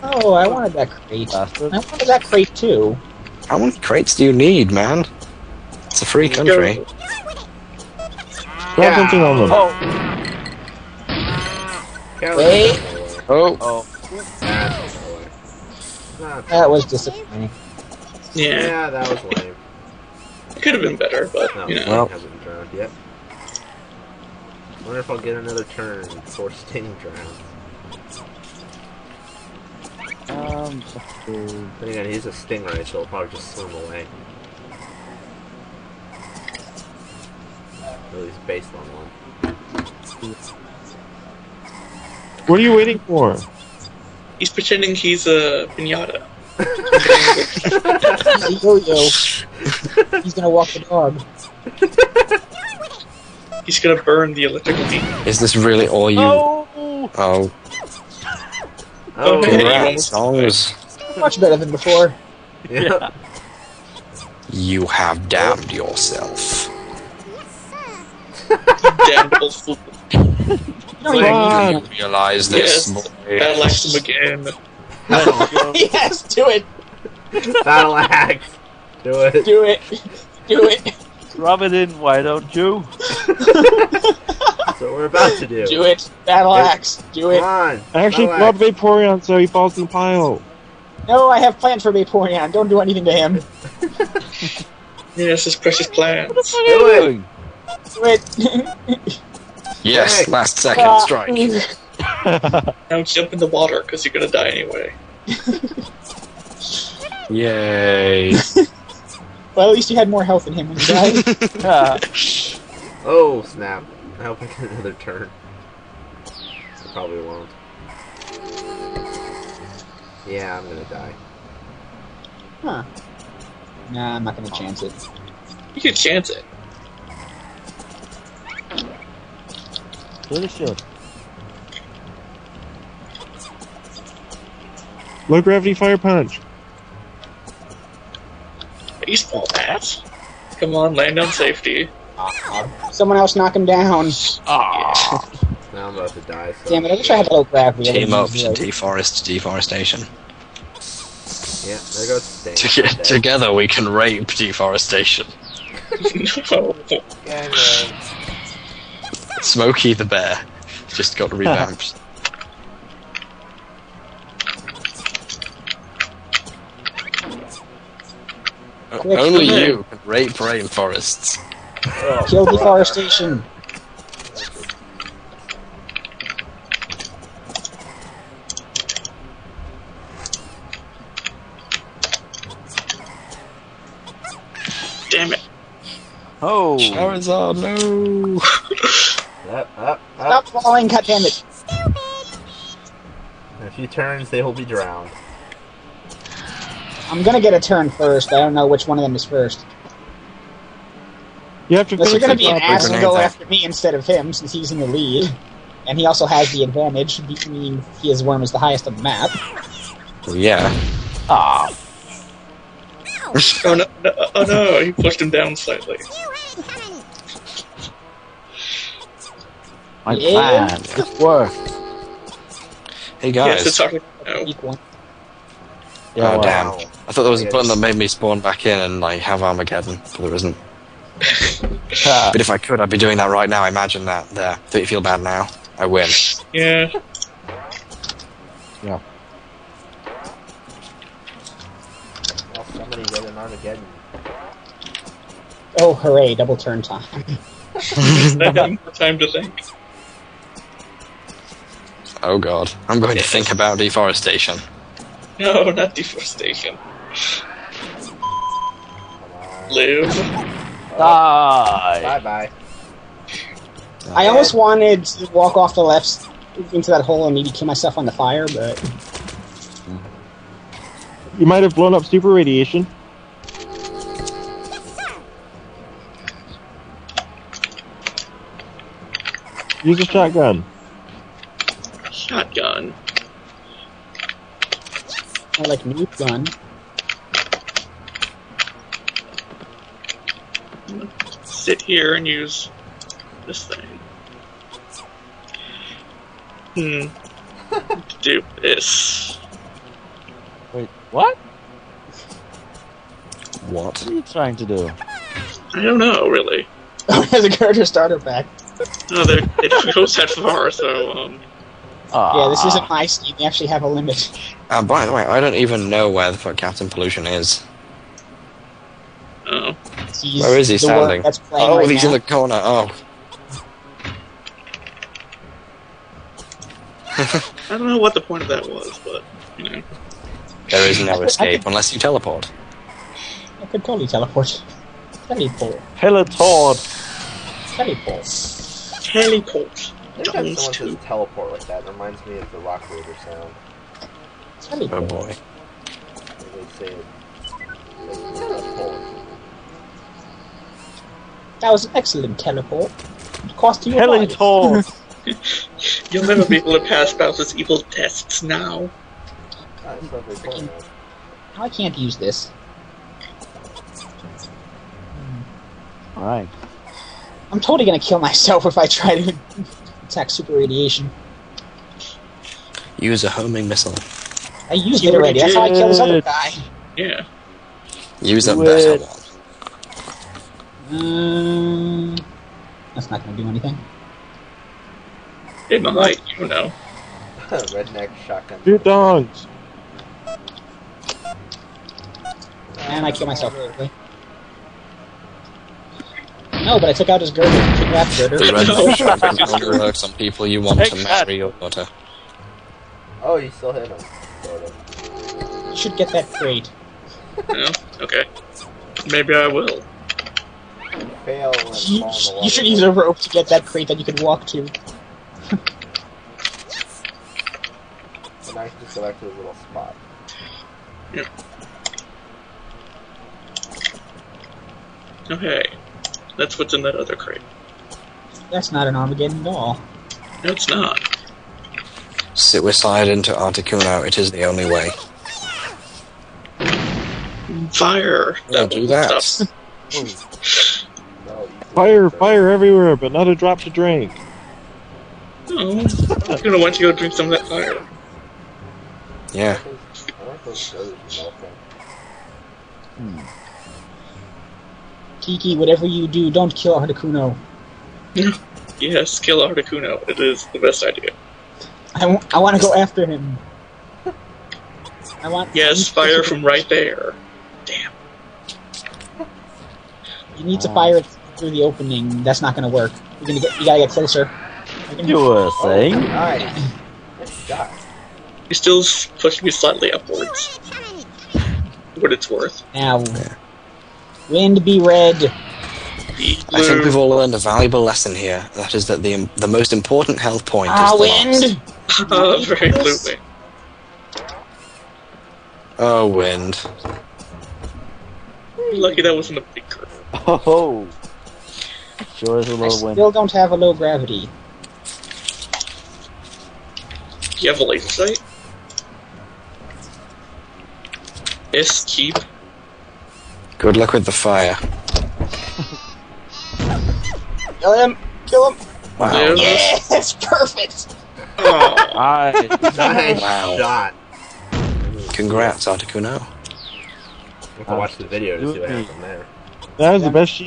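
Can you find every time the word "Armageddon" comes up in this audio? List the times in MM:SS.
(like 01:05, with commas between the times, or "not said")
03:49, 07:08.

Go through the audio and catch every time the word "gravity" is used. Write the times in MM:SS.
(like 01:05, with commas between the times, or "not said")
02:15, 02:27, 08:23.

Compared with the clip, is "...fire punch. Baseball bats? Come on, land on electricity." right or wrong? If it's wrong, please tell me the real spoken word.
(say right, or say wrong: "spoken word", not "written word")
wrong: "safety", not "electricity".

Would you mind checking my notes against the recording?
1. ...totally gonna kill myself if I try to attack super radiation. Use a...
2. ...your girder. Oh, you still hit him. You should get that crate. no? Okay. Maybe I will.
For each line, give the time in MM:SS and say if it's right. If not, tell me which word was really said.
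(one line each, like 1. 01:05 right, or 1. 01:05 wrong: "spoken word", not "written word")
1. 06:07 right
2. 06:41 wrong: "daughter", not "girder".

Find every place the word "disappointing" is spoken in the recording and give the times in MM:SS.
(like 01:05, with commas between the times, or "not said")
00:16.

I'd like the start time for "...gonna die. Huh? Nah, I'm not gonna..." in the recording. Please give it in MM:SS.
02:00.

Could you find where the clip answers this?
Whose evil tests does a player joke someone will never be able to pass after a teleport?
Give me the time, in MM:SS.
05:57.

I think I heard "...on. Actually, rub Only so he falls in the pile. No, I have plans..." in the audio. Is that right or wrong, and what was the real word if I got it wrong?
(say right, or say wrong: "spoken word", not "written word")
wrong: "Vaporeon", not "Only".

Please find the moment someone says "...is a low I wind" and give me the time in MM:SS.
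08:22.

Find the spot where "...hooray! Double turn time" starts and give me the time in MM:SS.
04:05.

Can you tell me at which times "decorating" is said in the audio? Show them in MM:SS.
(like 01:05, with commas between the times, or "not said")
not said.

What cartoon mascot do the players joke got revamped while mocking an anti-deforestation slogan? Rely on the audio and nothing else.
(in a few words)
Smokey the Bear.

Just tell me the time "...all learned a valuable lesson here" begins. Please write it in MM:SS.
08:06.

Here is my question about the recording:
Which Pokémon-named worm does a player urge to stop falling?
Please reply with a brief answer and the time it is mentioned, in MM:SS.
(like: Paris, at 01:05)
Charizard, at 03:06.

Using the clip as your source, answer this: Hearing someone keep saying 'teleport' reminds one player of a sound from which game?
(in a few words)
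Rock Raider.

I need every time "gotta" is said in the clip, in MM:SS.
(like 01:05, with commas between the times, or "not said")
07:53.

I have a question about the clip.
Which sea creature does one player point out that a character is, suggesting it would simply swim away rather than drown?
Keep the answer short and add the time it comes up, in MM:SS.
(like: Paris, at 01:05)
Stingray, at 00:32.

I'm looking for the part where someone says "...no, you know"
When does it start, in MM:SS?
00:21.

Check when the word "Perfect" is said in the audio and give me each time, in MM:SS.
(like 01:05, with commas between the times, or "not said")
08:40.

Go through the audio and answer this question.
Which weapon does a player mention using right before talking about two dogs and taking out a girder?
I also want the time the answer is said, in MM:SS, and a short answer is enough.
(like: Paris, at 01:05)
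Redneck shotgun, at 06:27.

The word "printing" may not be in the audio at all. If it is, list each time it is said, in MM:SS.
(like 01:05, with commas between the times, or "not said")
not said.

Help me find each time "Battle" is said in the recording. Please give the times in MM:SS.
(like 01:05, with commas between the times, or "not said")
01:17, 01:26.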